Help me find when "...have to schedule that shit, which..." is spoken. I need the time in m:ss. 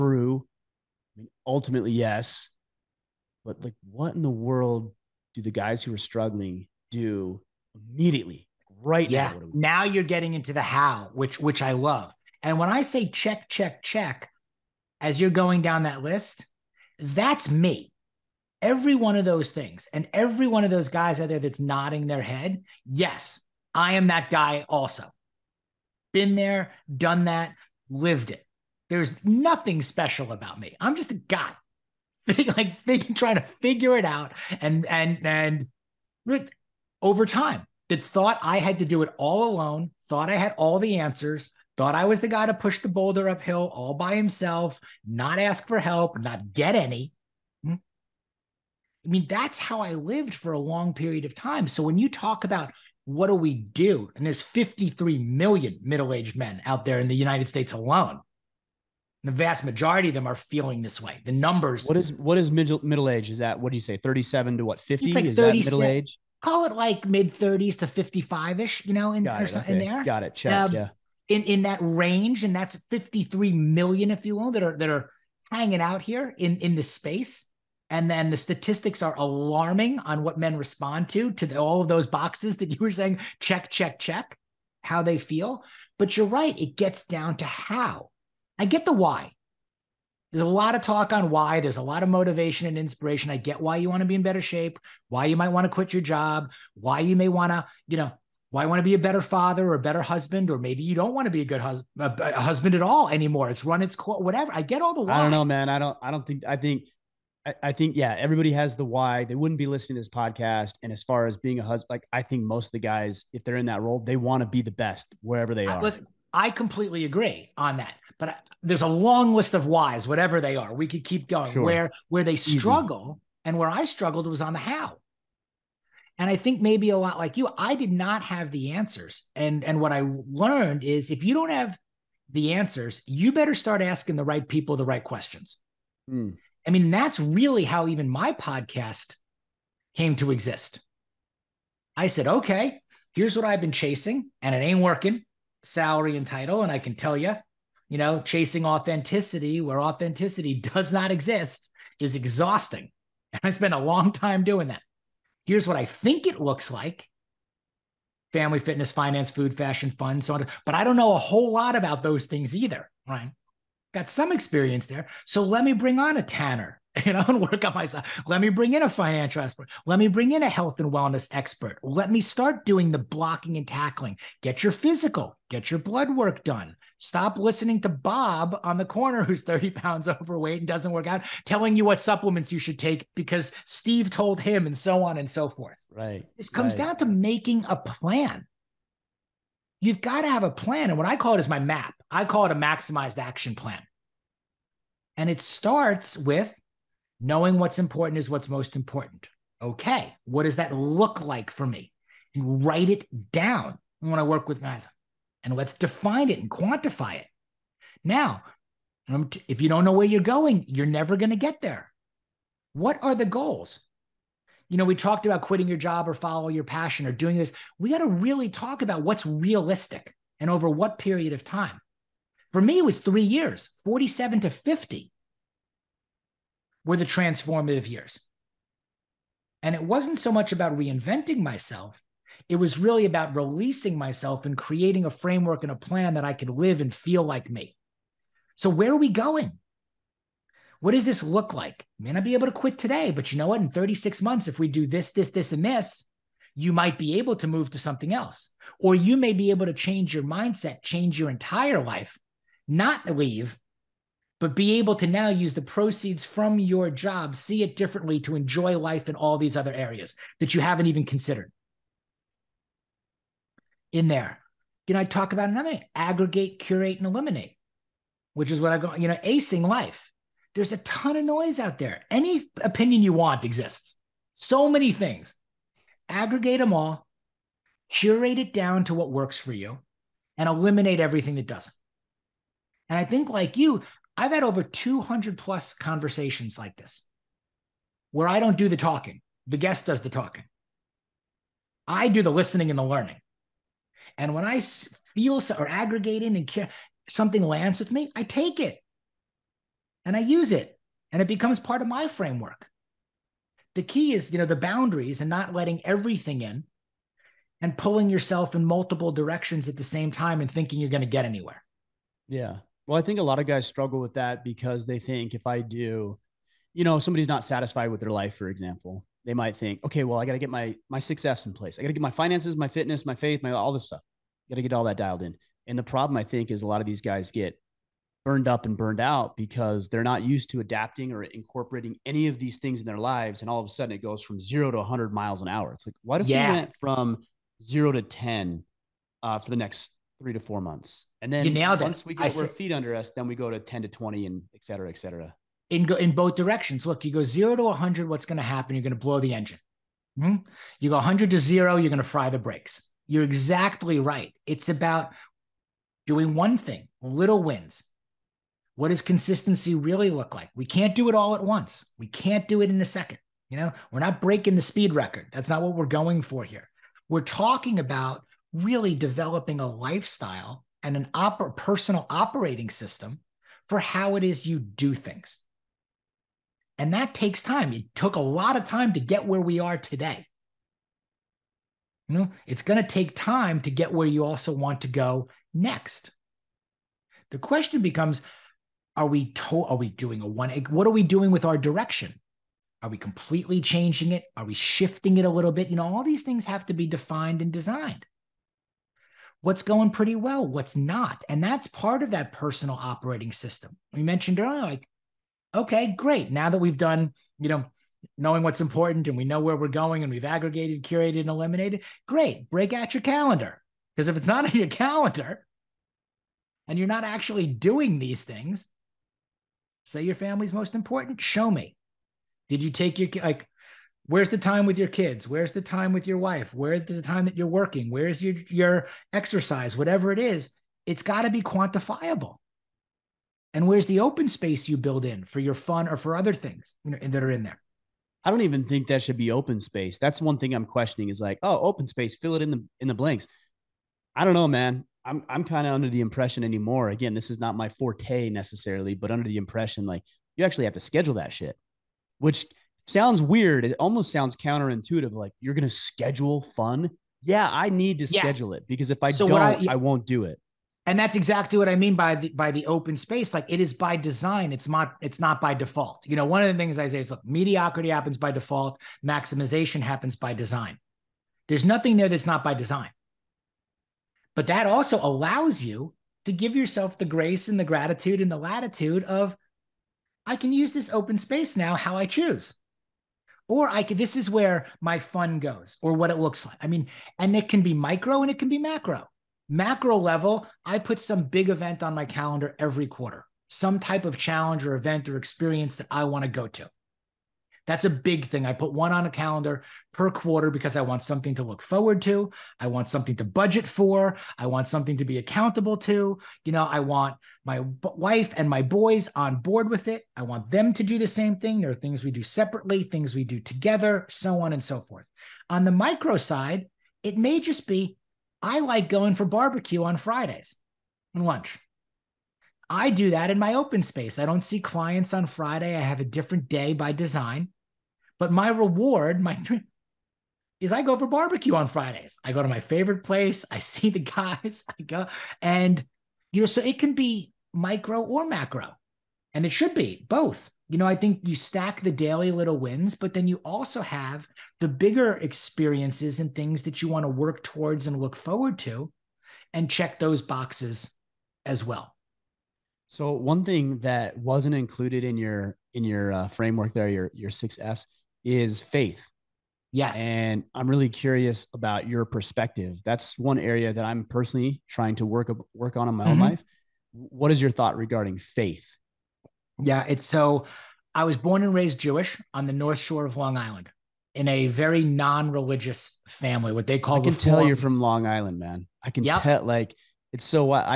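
7:30.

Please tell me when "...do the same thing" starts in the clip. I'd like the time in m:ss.
8:30.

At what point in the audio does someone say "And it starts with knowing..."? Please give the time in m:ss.
3:15.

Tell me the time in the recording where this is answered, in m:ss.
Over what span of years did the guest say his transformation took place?
3:43.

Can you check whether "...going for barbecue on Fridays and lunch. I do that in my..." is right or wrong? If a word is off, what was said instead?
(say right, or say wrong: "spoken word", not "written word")
right.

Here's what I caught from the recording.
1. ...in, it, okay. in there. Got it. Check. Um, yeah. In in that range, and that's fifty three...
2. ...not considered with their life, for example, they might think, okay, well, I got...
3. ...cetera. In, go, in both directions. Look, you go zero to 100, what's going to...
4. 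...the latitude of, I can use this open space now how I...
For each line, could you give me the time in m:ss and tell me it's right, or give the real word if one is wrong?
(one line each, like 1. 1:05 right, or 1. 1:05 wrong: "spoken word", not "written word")
1. 1:09 right
2. 5:17 wrong: "satisfied", not "considered"
3. 5:44 right
4. 7:58 right.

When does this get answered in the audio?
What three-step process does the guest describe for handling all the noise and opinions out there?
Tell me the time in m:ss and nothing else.
4:25.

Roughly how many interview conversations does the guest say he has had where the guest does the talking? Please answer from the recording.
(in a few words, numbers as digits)
200 plus.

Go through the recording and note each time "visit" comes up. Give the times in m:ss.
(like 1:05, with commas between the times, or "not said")
not said.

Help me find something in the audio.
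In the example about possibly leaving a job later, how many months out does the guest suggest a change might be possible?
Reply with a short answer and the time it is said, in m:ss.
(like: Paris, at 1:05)
36, at 4:03.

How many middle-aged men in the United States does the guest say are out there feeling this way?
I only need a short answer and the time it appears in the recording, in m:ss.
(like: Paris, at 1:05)
53 million, at 0:54.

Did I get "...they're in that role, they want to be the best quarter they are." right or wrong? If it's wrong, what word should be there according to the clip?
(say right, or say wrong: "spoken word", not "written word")
wrong: "wherever", not "quarter".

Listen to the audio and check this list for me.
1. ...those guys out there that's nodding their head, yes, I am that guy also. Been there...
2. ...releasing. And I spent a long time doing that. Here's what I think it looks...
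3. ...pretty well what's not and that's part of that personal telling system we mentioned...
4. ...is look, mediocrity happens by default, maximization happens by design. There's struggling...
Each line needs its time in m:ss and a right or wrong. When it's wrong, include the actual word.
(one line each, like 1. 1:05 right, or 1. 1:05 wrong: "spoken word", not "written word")
1. 0:20 right
2. 2:32 wrong: "exhausting", not "releasing"
3. 6:39 wrong: "operating", not "telling"
4. 7:47 wrong: "nothing", not "struggling".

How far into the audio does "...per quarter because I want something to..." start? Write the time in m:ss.
8:19.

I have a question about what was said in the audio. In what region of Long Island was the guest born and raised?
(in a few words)
North Shore.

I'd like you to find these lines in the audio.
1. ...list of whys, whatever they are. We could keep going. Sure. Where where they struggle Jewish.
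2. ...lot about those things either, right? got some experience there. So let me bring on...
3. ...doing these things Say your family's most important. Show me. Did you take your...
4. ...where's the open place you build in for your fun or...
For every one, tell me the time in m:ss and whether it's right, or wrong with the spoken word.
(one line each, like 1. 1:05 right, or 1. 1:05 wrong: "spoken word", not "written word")
1. 1:59 wrong: "Easy", not "Jewish"
2. 2:41 right
3. 6:57 right
4. 7:13 wrong: "space", not "place".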